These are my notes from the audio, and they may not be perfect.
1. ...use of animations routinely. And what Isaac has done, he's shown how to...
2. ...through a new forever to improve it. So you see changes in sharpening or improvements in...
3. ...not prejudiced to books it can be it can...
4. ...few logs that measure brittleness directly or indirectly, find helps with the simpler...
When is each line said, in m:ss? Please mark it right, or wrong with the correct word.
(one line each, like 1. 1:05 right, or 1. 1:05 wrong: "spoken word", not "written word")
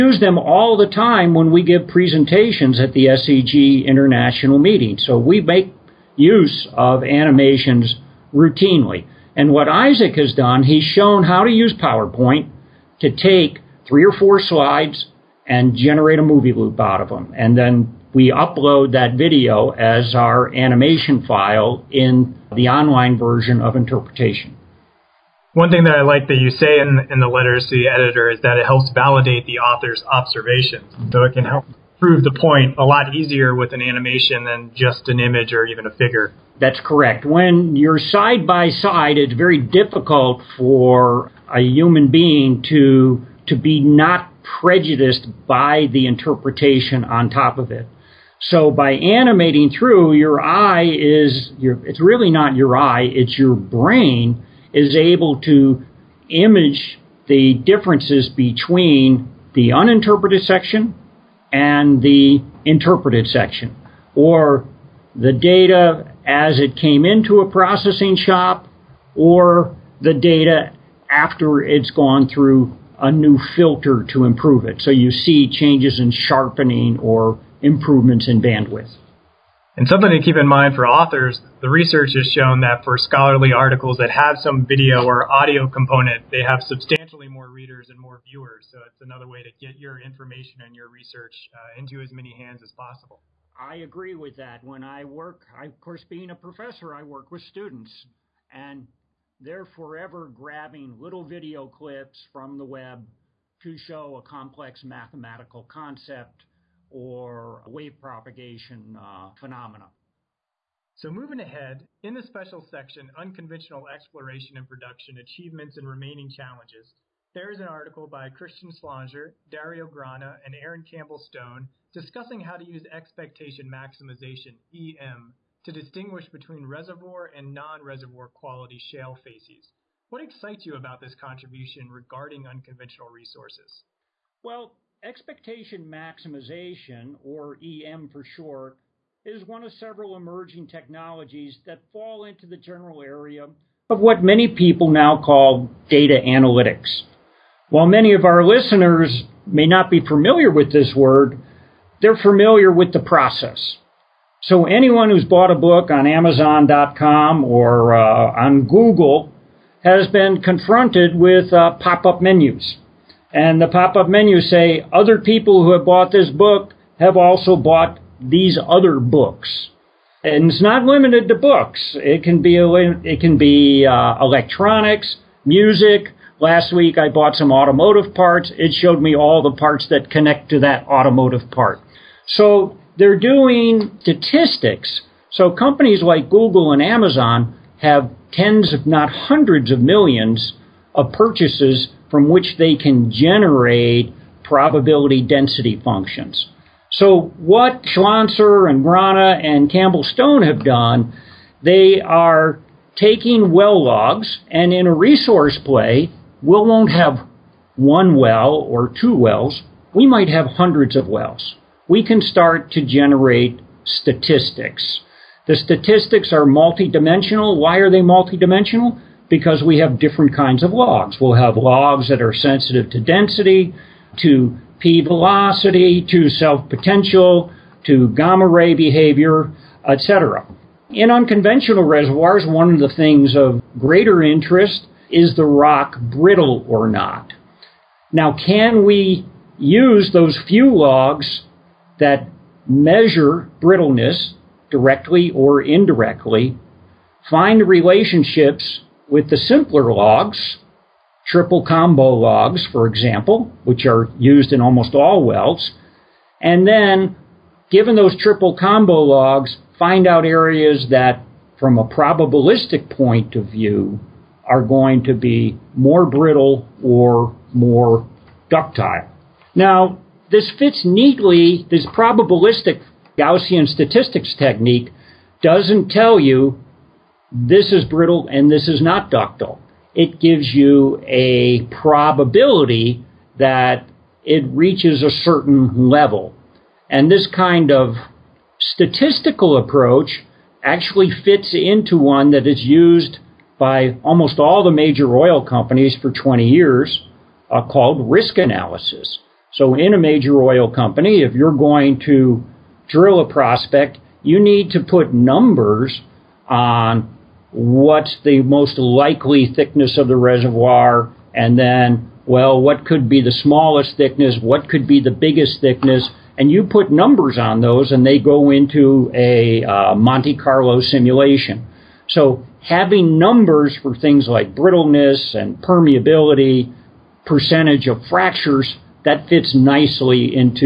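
1. 0:06 right
2. 1:12 wrong: "filter", not "forever"
3. 2:50 wrong: "limited", not "prejudiced"
4. 4:00 wrong: "relationships", not "helps".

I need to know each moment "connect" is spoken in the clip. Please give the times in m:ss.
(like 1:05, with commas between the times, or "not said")
3:00.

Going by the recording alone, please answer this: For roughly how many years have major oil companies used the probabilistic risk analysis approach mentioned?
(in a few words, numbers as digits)
20 years.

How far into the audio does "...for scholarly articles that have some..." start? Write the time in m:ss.
1:22.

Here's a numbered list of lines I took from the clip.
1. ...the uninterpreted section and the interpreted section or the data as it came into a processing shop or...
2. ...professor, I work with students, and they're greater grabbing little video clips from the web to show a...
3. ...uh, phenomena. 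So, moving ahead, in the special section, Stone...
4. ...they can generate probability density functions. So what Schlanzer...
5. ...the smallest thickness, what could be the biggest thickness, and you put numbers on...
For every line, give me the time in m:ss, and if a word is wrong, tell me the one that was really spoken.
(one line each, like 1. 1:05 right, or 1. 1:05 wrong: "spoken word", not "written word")
1. 0:59 right
2. 1:36 wrong: "forever", not "greater"
3. 1:48 wrong: "Unconventional", not "Stone"
4. 3:12 right
5. 5:13 right.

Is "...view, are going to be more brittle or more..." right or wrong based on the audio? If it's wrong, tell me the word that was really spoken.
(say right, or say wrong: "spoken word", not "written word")
right.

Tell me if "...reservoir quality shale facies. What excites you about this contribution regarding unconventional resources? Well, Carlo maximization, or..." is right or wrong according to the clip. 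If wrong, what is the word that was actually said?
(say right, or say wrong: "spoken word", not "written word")
wrong: "Expectation", not "Carlo".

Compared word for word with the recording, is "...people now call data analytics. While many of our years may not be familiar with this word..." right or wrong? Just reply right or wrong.
wrong.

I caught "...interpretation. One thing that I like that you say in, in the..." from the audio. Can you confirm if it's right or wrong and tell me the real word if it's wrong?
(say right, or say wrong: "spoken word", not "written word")
right.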